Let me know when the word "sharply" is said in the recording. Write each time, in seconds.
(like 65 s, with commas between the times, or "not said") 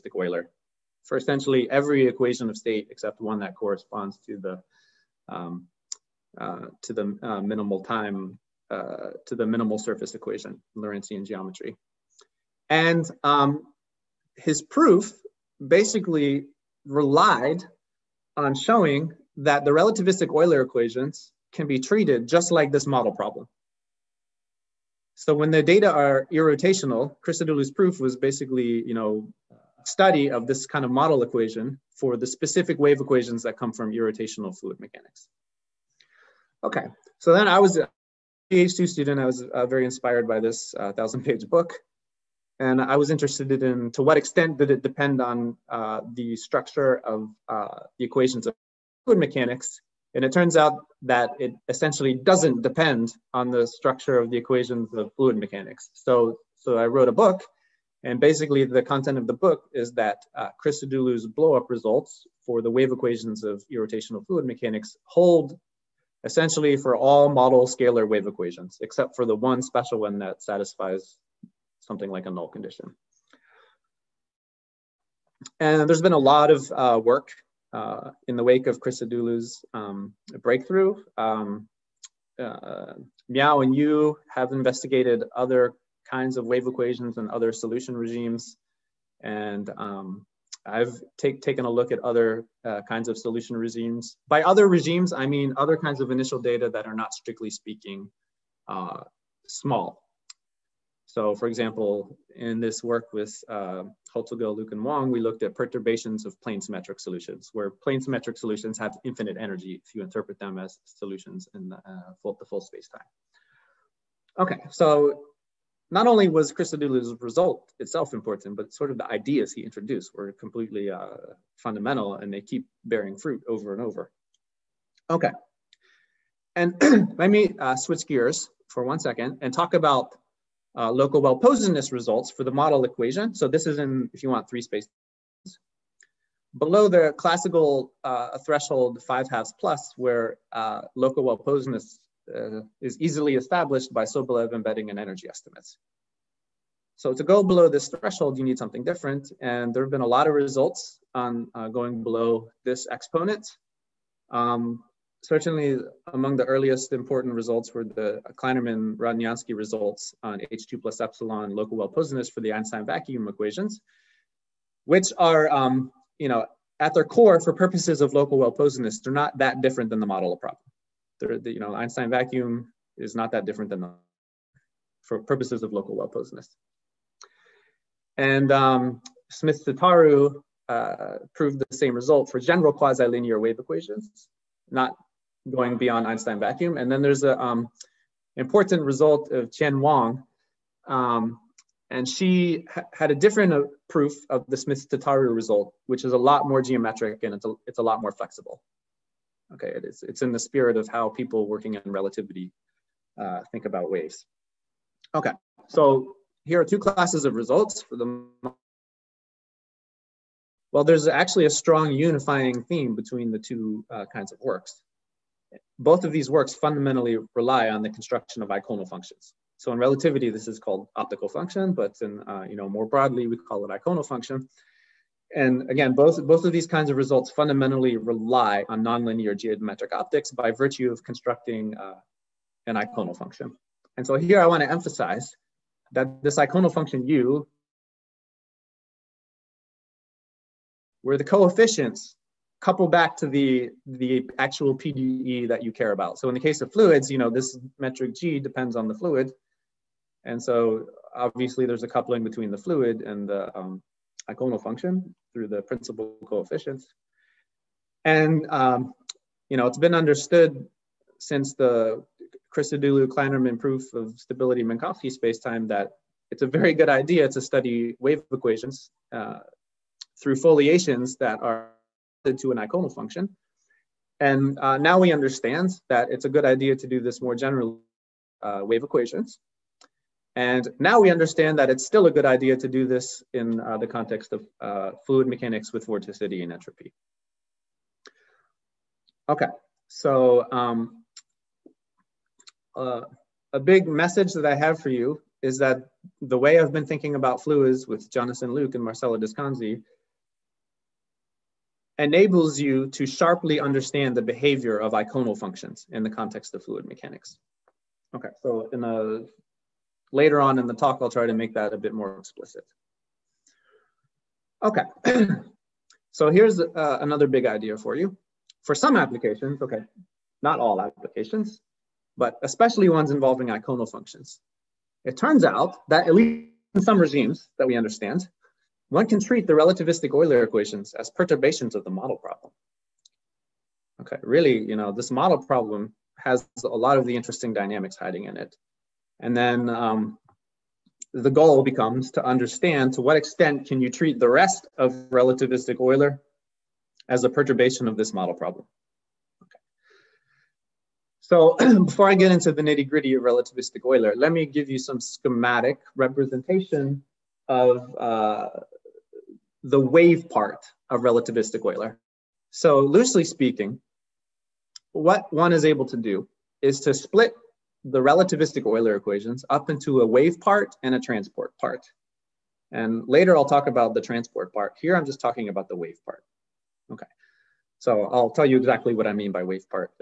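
303 s.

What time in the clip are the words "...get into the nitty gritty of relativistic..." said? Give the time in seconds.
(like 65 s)
352 s.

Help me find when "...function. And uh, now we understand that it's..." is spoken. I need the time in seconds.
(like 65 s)
272 s.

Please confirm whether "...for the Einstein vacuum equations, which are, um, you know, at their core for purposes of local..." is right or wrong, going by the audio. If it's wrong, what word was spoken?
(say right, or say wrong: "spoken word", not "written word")
right.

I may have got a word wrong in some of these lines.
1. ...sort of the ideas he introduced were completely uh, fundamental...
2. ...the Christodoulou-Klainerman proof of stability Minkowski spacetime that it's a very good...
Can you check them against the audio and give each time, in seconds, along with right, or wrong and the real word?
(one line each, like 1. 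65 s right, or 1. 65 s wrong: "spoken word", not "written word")
1. 118 s right
2. 261 s right.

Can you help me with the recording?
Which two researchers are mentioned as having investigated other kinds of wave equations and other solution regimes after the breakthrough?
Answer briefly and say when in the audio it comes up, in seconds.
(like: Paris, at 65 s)
Miao and Yu, at 83 s.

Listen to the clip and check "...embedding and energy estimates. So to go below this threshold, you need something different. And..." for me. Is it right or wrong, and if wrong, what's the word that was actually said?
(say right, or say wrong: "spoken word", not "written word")
right.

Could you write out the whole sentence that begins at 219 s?
So in relativity, this is called optical function, but in, uh, you know, more broadly, we call it eikonal function.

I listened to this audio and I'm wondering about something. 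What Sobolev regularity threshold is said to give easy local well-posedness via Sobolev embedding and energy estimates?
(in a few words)
5/2+.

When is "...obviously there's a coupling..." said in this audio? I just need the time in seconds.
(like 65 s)
251 s.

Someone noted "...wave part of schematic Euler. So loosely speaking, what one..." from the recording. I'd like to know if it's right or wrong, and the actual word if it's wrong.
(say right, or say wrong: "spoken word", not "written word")
wrong: "relativistic", not "schematic".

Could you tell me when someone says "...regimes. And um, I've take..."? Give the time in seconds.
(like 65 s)
87 s.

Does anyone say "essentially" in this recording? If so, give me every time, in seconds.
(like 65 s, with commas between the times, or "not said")
1 s, 51 s, 66 s.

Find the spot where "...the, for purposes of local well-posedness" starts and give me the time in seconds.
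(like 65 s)
173 s.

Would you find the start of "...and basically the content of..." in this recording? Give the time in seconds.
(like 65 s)
58 s.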